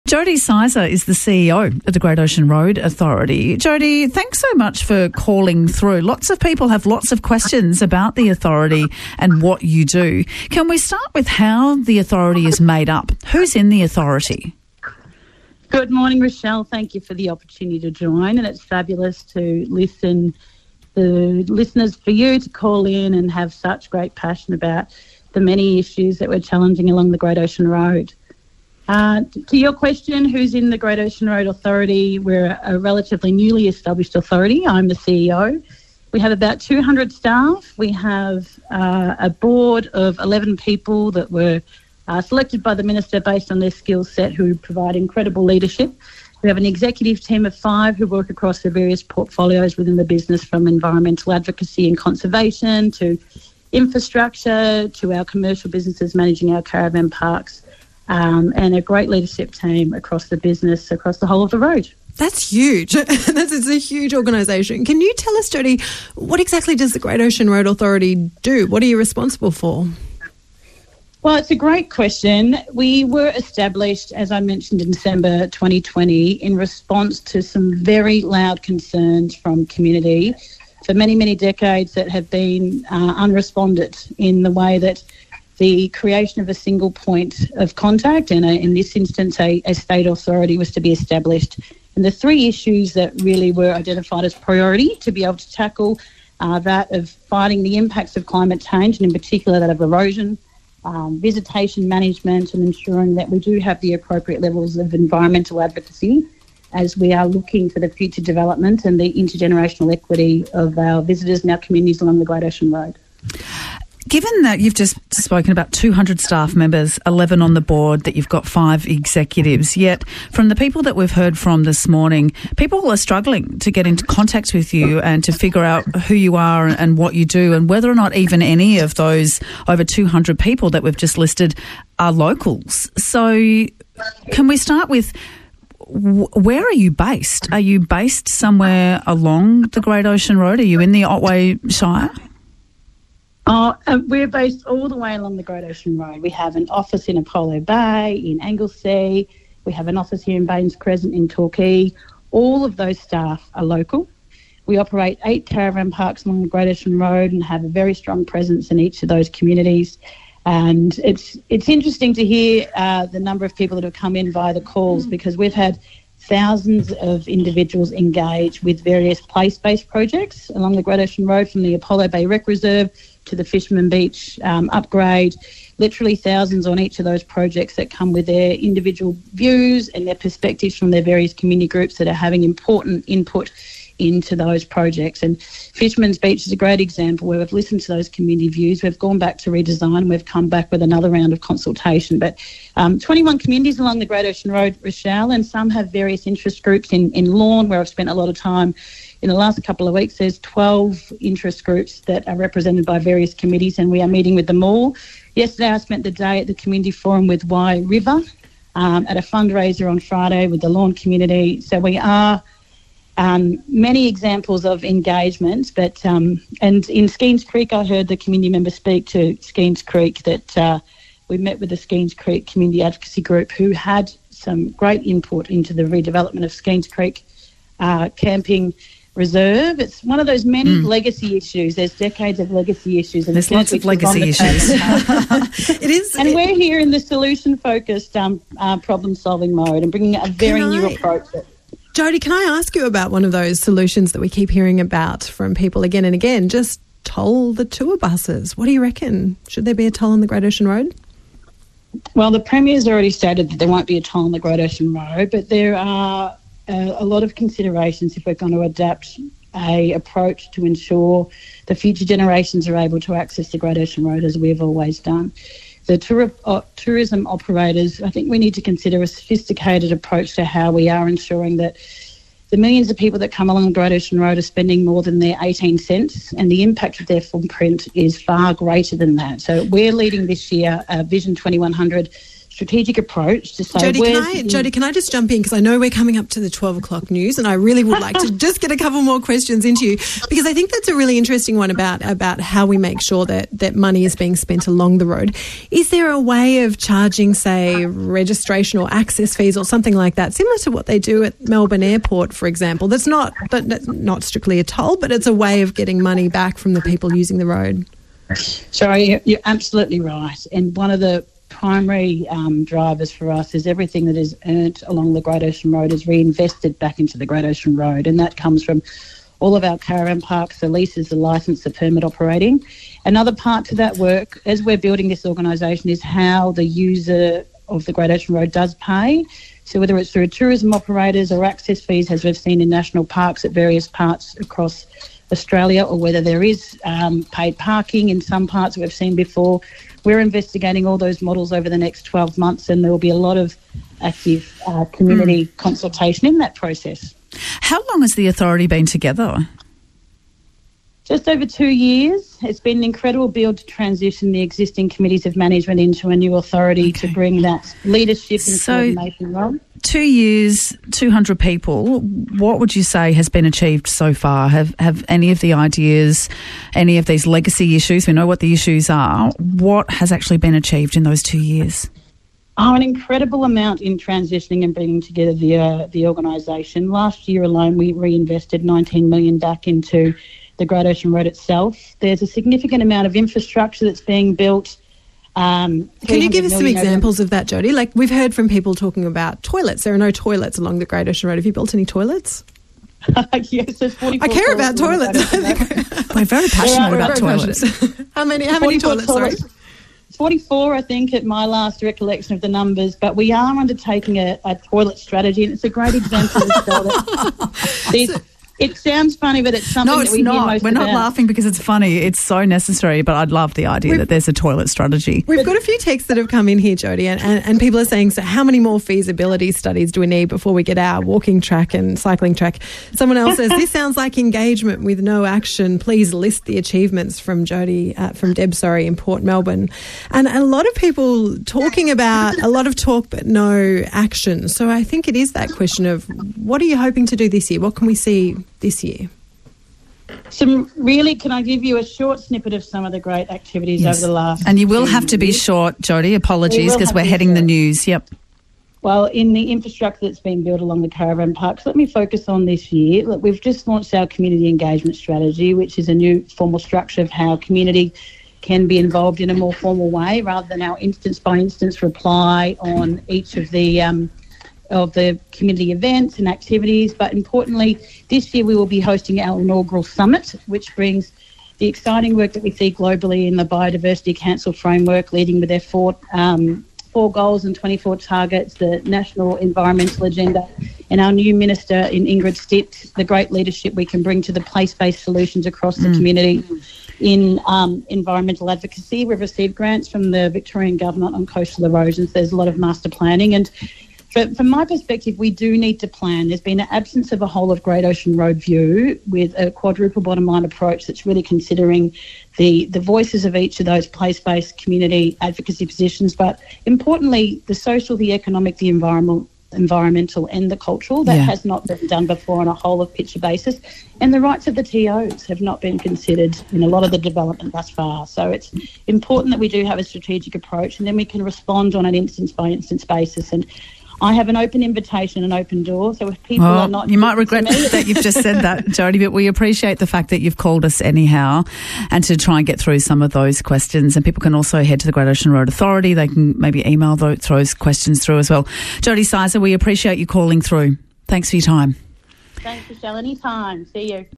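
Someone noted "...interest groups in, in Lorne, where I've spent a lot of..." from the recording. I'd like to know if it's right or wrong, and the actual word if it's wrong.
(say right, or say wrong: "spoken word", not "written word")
right.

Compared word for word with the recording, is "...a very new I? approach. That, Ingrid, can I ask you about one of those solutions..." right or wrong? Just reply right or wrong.
wrong.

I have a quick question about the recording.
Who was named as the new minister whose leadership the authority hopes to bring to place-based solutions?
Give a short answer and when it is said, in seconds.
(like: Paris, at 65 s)
Ingrid Stitt, at 482 s.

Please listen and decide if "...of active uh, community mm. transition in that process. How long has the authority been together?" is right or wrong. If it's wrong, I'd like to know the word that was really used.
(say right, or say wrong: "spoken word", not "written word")
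wrong: "consultation", not "transition".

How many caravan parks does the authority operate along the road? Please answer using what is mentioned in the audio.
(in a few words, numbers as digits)
8.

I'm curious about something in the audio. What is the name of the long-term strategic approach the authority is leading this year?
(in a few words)
Vision 2100.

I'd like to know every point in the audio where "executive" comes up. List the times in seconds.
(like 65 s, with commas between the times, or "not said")
46 s, 118 s.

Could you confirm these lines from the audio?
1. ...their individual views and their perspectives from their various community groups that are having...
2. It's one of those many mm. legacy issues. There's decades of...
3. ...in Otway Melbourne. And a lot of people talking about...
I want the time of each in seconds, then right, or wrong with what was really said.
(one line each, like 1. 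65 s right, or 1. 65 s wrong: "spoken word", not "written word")
1. 178 s right
2. 229 s right
3. 428 s wrong: "Port", not "Otway".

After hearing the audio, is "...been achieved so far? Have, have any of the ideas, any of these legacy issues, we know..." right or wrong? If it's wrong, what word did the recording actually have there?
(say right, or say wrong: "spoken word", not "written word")
right.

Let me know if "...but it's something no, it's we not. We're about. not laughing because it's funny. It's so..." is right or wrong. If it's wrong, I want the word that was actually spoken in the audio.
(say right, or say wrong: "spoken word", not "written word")
right.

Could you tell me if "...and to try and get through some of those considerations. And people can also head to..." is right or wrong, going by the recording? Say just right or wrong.
wrong.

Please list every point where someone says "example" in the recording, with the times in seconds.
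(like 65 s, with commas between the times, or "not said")
186 s, 214 s, 302 s, 386 s, 405 s.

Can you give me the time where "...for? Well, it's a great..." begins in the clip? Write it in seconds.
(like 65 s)
69 s.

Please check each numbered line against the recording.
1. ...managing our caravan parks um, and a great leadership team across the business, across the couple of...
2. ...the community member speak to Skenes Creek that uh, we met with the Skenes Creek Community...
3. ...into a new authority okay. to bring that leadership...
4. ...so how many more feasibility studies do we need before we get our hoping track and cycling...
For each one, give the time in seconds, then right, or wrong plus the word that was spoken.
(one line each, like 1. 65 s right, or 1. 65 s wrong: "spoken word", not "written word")
1. 56 s wrong: "whole", not "couple"
2. 218 s right
3. 355 s right
4. 418 s wrong: "walking", not "hoping".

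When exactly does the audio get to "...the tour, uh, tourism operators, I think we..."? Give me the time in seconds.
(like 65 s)
265 s.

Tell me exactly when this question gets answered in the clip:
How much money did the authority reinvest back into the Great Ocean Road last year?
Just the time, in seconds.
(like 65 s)
378 s.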